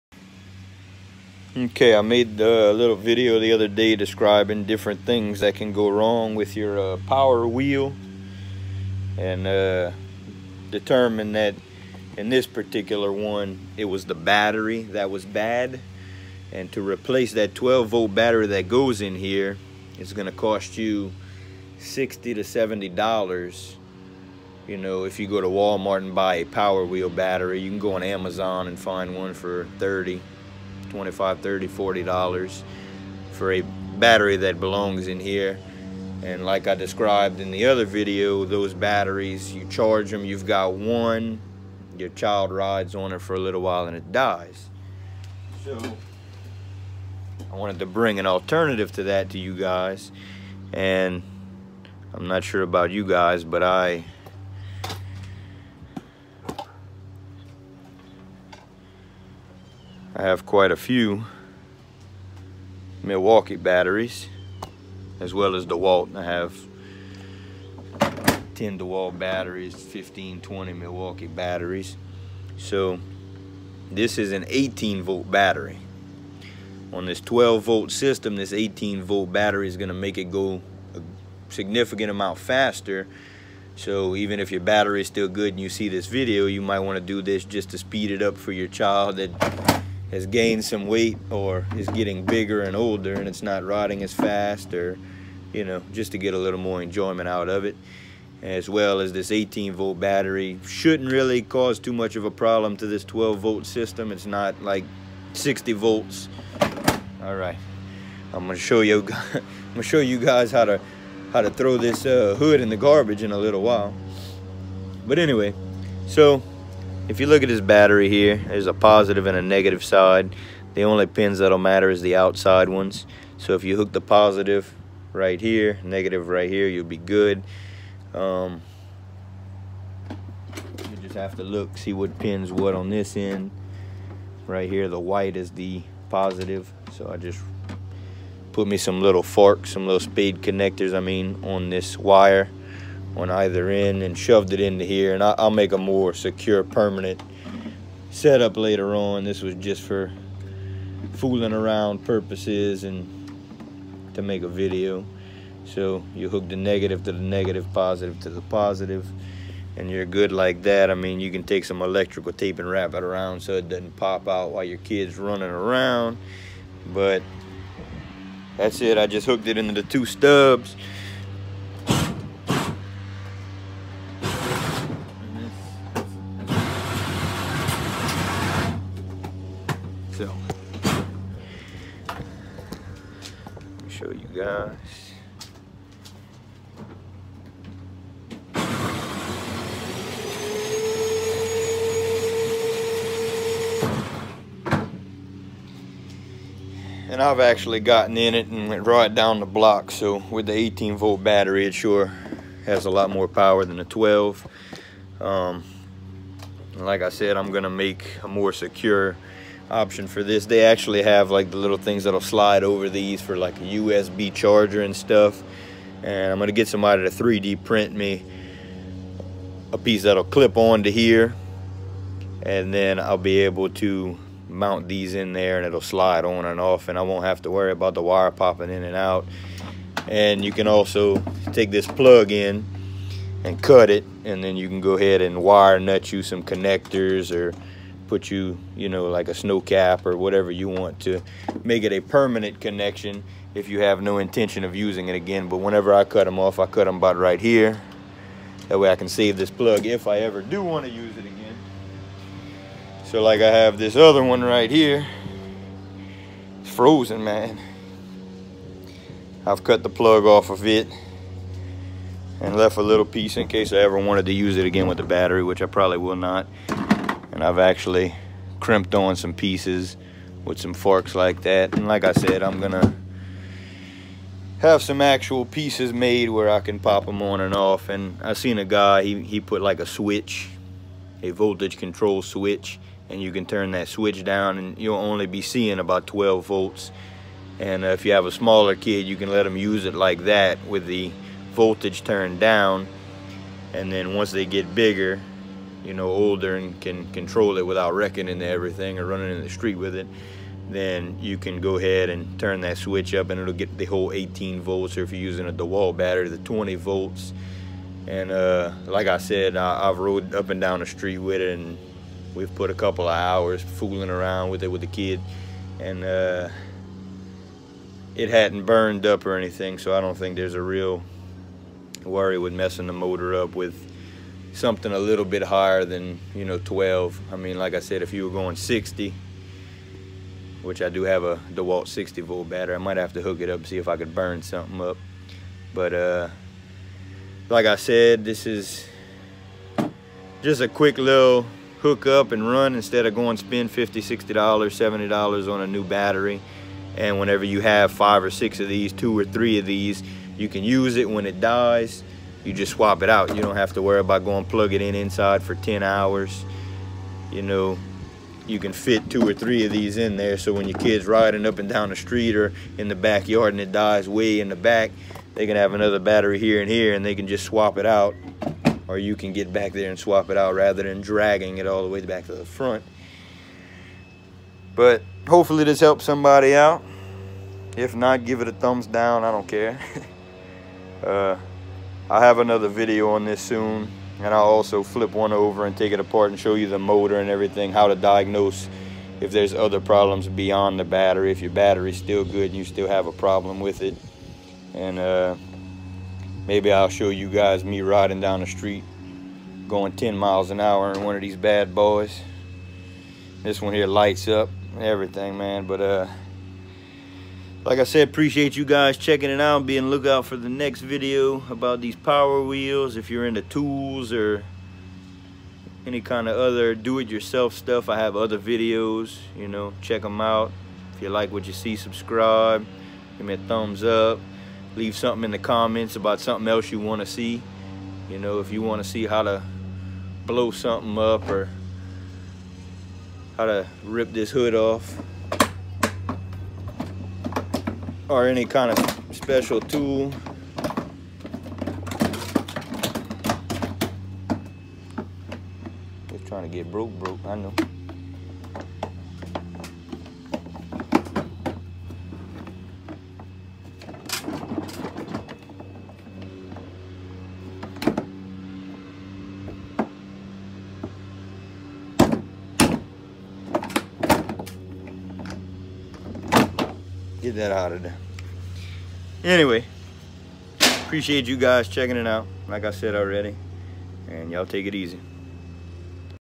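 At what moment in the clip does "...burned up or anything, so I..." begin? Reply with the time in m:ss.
5:18.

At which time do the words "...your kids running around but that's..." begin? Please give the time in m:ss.
2:44.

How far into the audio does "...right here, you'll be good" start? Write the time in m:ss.
2:06.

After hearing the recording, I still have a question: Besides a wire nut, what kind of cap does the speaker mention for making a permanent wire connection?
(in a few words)
Snow cap.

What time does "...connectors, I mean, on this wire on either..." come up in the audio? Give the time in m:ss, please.
2:20.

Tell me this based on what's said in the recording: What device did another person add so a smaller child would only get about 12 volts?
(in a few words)
Voltage control switch.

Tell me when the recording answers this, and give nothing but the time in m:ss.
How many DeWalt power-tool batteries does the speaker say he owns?
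1:08.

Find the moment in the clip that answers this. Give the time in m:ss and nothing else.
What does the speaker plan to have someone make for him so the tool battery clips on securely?
3:37.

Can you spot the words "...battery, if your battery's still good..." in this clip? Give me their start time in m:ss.
6:30.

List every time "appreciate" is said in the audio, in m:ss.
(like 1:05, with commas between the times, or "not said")
6:48, 7:50.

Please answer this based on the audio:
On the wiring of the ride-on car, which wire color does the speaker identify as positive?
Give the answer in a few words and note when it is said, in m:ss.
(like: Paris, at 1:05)
White, at 2:14.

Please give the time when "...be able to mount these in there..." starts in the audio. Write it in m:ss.
3:43.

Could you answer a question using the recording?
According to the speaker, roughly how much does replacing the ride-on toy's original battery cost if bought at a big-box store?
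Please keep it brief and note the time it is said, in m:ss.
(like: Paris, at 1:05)
60 to 70 dollars, at 0:21.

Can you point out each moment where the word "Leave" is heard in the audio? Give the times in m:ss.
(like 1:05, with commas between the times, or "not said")
7:04.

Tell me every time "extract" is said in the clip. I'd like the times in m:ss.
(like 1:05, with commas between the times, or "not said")
not said.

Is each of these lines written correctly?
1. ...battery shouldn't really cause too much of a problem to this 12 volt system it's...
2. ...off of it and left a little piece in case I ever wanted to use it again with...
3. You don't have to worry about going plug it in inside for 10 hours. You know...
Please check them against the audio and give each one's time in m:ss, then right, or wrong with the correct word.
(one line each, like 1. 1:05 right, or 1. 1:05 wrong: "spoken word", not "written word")
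1. 1:40 right
2. 4:20 right
3. 5:53 right.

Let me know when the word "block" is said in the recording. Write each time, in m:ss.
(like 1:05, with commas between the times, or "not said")
3:19.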